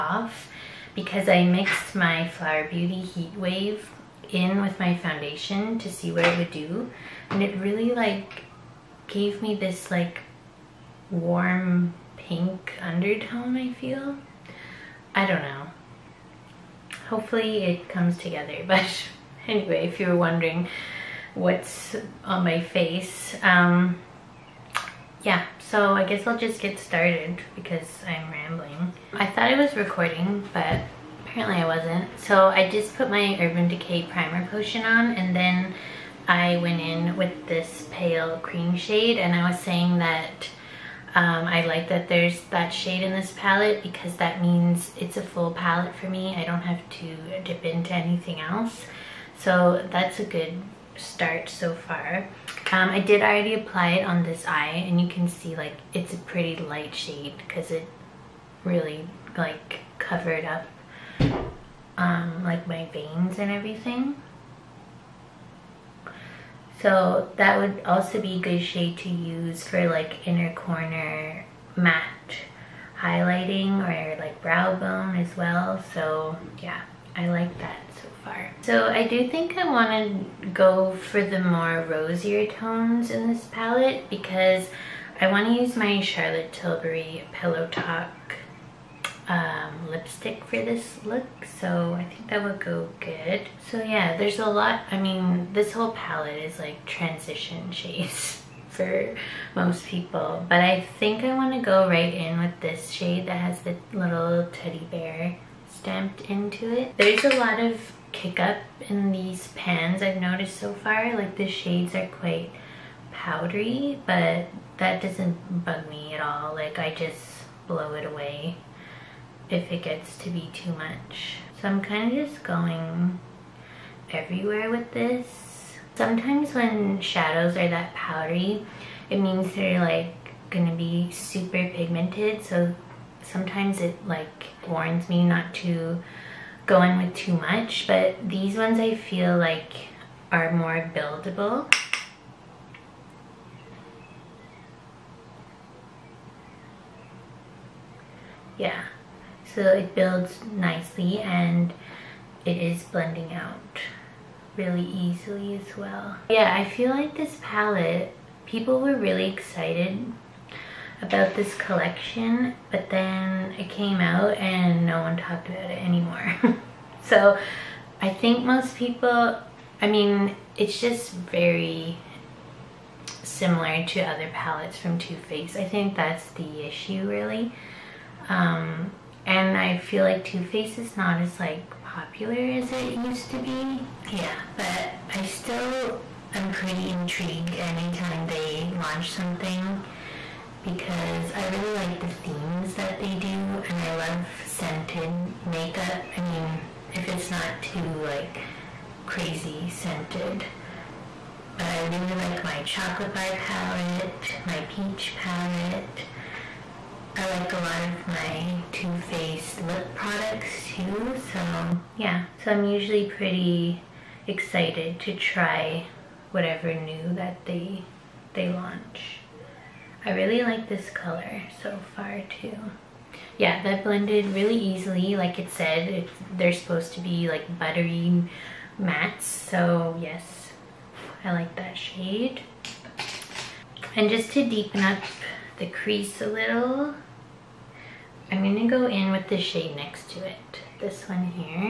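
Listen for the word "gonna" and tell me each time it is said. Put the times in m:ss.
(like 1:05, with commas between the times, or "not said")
2:10, 3:58.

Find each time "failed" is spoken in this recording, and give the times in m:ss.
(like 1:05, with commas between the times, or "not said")
not said.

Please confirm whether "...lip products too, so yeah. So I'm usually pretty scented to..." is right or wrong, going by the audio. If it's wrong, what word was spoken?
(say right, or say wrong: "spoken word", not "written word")
wrong: "excited", not "scented".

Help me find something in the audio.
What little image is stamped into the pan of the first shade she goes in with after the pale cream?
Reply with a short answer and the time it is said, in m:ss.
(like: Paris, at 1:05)
teddy bear, at 1:44.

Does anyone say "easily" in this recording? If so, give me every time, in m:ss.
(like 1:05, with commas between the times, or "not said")
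2:34, 3:44.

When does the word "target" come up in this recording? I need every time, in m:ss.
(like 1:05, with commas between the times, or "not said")
not said.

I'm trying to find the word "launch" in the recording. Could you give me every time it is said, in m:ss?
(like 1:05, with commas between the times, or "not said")
3:08, 3:38.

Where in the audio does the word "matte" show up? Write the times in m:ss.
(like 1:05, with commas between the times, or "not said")
1:11, 3:48.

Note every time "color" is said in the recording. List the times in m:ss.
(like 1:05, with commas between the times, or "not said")
3:40.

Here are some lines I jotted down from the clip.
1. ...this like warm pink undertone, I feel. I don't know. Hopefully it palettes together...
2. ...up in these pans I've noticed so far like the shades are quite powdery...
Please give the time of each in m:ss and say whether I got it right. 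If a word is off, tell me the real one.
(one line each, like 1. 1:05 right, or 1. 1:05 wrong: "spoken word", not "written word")
1. 0:09 wrong: "comes", not "palettes"
2. 1:48 right.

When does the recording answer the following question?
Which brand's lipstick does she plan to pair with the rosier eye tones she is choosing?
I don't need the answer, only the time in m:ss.
1:26.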